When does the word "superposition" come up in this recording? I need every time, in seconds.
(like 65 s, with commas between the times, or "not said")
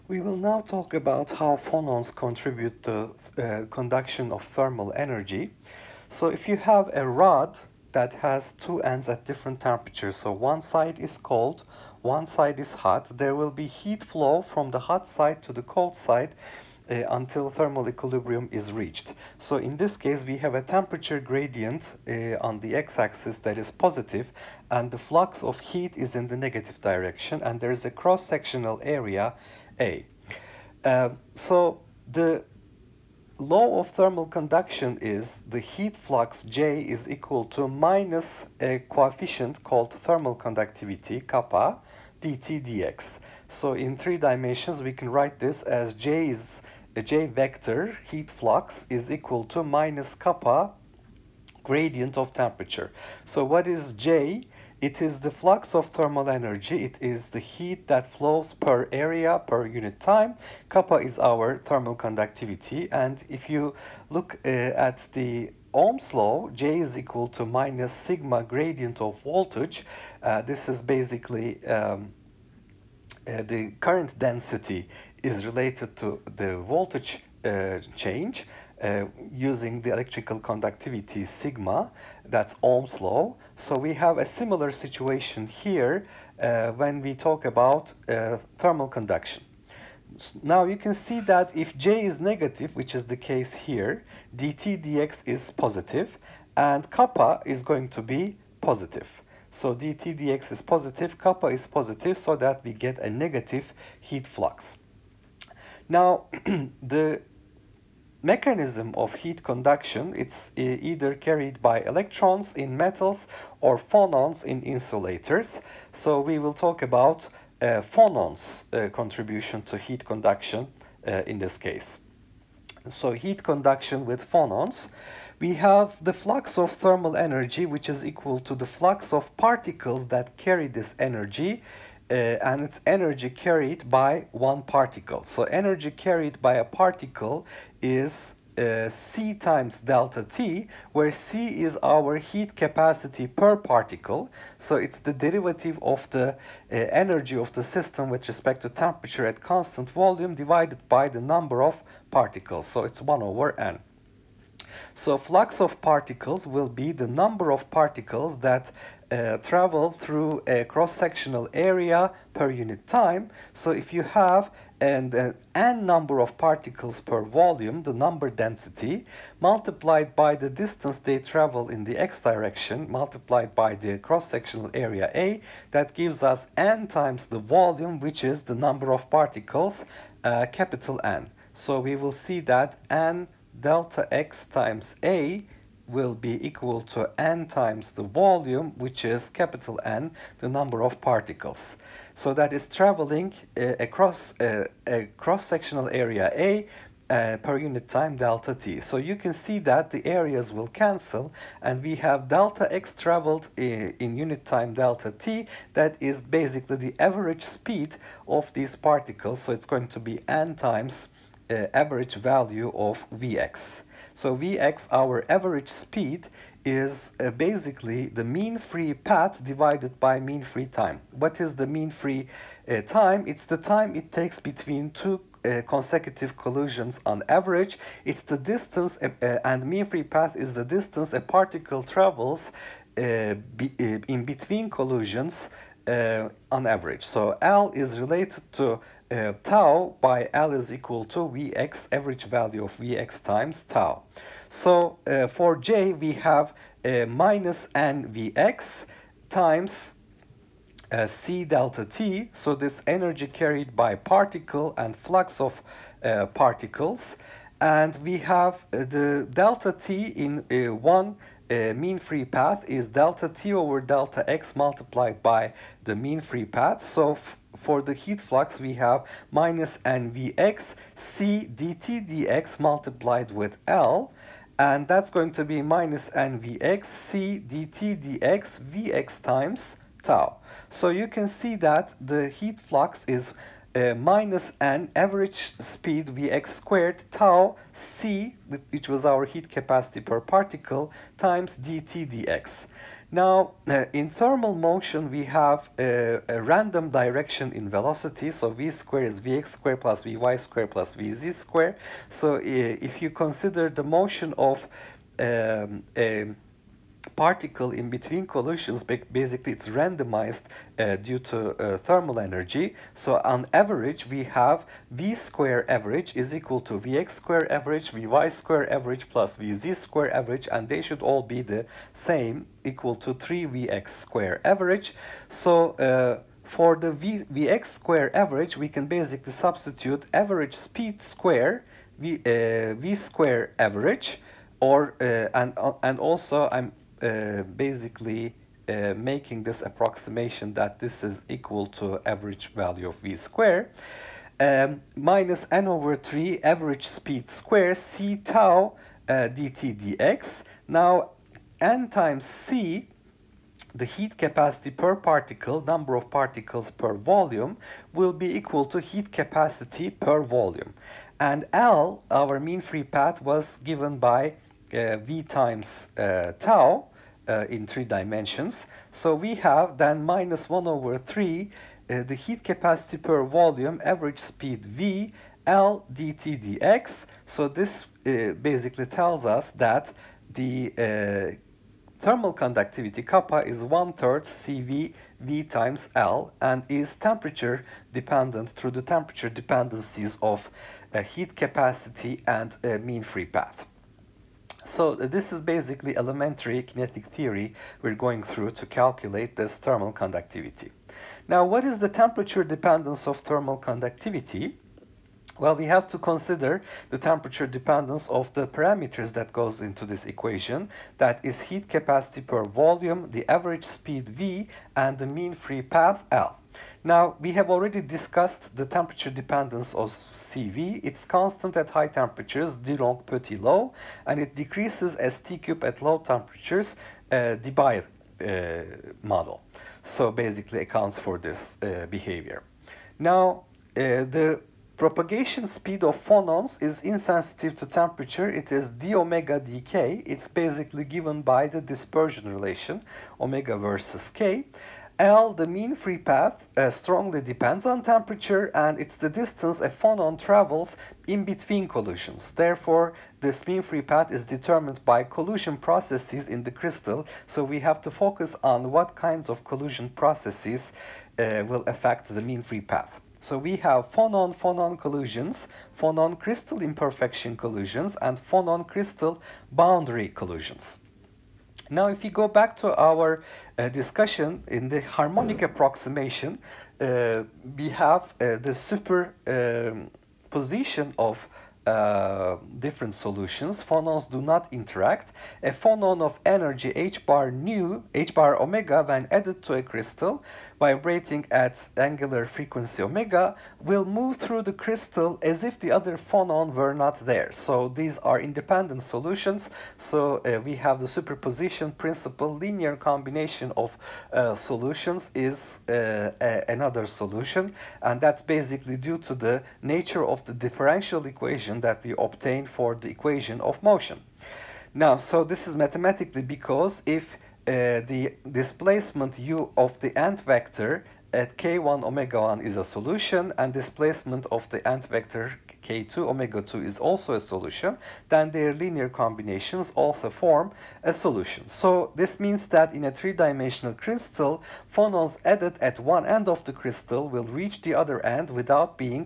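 478 s, 500 s.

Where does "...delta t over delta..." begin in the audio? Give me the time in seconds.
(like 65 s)
262 s.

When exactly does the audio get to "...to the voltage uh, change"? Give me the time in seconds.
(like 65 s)
75 s.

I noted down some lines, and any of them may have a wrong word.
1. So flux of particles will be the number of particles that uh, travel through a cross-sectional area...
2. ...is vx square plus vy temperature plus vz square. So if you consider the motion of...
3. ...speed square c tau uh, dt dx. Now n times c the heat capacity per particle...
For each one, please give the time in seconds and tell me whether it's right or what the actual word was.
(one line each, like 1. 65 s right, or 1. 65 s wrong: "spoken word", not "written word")
1. 154 s right
2. 299 s wrong: "square", not "temperature"
3. 346 s right.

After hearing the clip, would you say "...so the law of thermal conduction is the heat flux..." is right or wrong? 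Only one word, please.
right.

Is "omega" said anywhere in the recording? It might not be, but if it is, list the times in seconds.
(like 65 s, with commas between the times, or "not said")
438 s, 443 s, 488 s, 492 s, 521 s, 525 s.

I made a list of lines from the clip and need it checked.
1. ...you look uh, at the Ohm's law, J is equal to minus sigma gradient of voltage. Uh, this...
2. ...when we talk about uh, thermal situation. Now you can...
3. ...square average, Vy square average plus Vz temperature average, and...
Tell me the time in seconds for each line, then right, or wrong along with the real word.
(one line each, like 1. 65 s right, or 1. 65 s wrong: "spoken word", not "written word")
1. 63 s right
2. 86 s wrong: "conduction", not "situation"
3. 317 s wrong: "square", not "temperature".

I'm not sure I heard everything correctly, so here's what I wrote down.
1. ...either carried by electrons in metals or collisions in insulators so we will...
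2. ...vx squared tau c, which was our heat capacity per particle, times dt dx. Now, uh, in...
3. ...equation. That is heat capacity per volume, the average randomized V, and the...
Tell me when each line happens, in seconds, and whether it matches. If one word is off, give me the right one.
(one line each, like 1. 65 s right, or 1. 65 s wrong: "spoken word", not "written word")
1. 110 s wrong: "phonons", not "collisions"
2. 286 s right
3. 410 s wrong: "speed", not "randomized".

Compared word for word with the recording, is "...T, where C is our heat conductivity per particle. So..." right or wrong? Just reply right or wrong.
wrong.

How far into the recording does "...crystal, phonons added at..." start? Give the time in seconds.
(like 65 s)
533 s.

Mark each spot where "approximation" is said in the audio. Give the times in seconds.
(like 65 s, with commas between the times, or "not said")
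339 s, 475 s.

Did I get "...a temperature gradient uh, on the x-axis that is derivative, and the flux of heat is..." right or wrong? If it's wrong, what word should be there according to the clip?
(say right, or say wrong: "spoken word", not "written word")
wrong: "positive", not "derivative".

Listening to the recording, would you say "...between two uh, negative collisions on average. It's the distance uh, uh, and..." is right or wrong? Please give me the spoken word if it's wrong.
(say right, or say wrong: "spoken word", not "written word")
wrong: "consecutive", not "negative".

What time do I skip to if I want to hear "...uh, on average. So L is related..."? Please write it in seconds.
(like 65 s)
235 s.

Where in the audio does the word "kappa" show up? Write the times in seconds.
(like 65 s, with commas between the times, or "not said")
41 s, 50 s, 60 s, 96 s, 101 s, 383 s.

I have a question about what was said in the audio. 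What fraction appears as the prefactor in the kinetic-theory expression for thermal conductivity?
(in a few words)
one-third.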